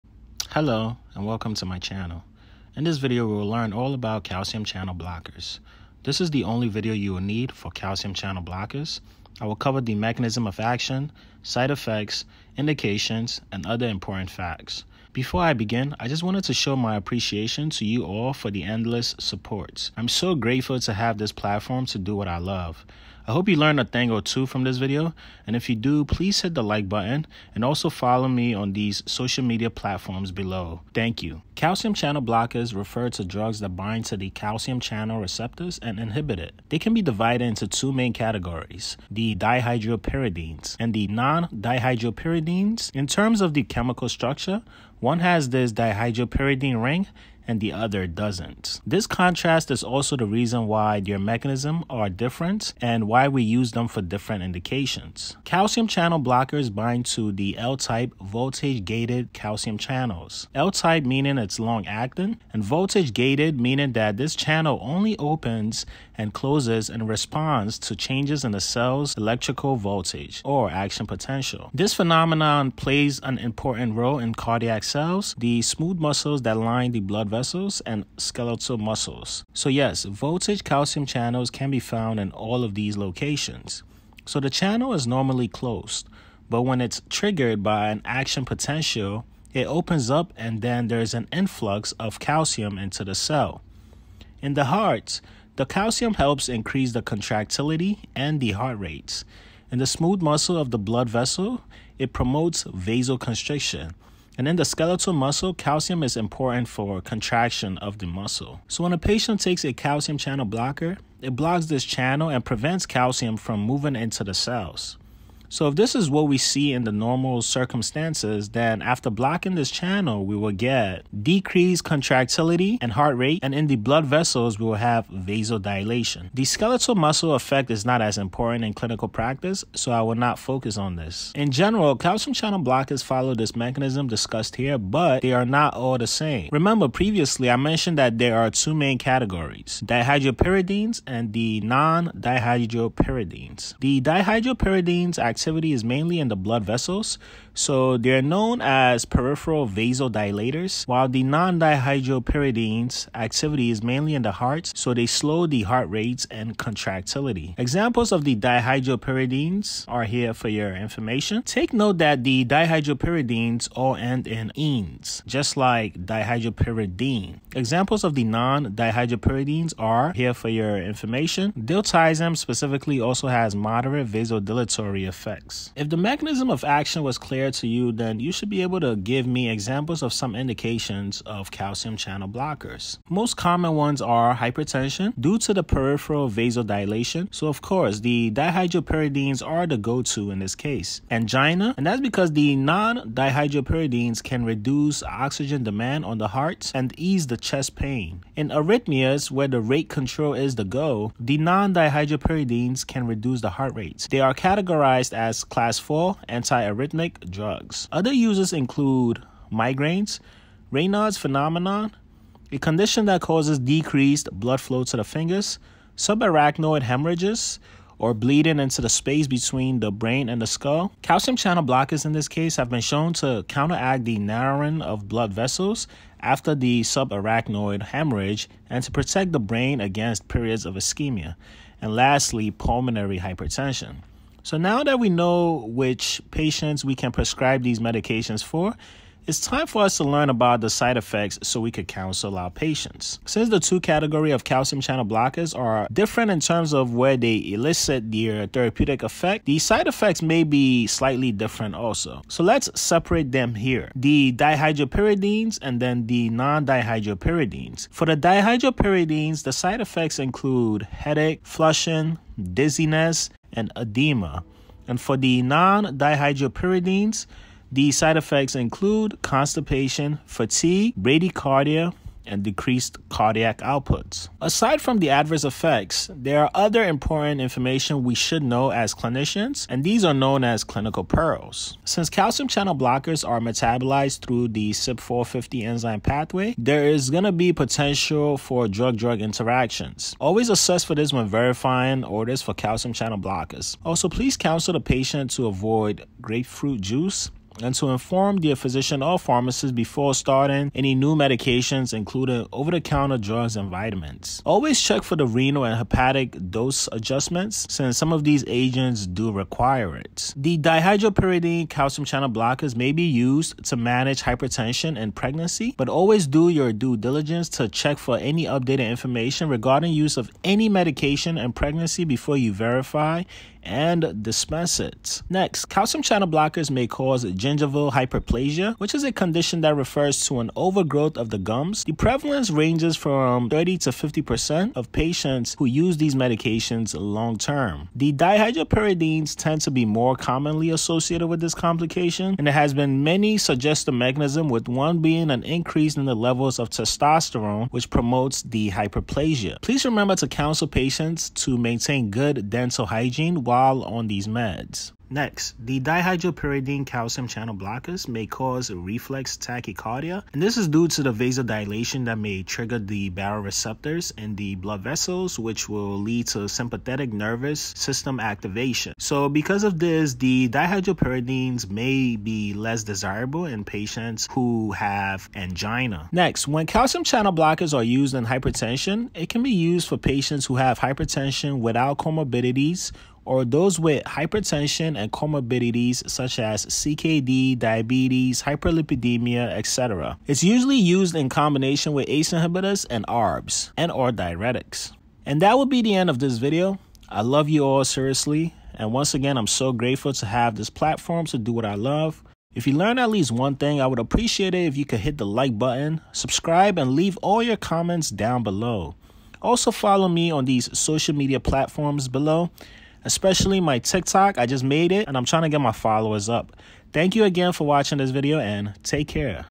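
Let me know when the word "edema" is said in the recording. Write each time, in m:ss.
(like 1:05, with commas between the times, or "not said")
4:23.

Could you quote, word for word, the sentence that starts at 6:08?
So because of this, the dihydropyridines may be less desirable in patients who have angina.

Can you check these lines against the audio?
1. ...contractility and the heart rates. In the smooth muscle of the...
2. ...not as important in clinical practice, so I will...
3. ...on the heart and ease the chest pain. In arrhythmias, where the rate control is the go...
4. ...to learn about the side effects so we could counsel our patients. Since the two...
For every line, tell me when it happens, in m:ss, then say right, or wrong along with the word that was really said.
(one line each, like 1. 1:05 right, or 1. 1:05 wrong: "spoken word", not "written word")
1. 1:37 right
2. 2:07 right
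3. 3:16 right
4. 3:59 right.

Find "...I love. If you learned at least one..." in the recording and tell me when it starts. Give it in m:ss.
6:41.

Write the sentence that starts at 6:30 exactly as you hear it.
It's usually used in combination with ACE inhibitors and ARBs and or diuretics.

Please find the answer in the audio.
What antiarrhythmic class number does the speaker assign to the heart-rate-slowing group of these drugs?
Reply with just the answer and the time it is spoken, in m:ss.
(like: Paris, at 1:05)
4, at 3:25.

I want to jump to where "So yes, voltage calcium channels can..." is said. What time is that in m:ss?
1:19.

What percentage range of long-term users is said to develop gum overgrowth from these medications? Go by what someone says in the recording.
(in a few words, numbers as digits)
30 to 50%.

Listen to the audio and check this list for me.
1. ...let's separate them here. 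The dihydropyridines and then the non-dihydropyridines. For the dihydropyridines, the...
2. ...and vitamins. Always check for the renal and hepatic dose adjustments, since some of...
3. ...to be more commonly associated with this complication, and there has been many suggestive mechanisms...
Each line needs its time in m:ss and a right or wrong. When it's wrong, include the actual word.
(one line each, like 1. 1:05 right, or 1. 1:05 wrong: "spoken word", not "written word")
1. 4:12 right
2. 5:03 right
3. 5:39 right.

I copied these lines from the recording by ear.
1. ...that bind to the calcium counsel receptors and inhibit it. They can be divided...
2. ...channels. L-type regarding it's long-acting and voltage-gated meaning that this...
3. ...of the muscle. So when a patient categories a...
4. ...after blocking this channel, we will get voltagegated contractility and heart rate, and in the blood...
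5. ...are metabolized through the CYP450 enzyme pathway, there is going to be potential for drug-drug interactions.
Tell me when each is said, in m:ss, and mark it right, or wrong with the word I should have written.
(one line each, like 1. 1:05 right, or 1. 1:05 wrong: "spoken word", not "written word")
1. 0:33 wrong: "channel", not "counsel"
2. 0:59 wrong: "meaning", not "regarding"
3. 1:47 wrong: "takes", not "categories"
4. 1:58 wrong: "decreased", not "voltagegated"
5. 4:43 right.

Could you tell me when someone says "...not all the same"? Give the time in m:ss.
2:15.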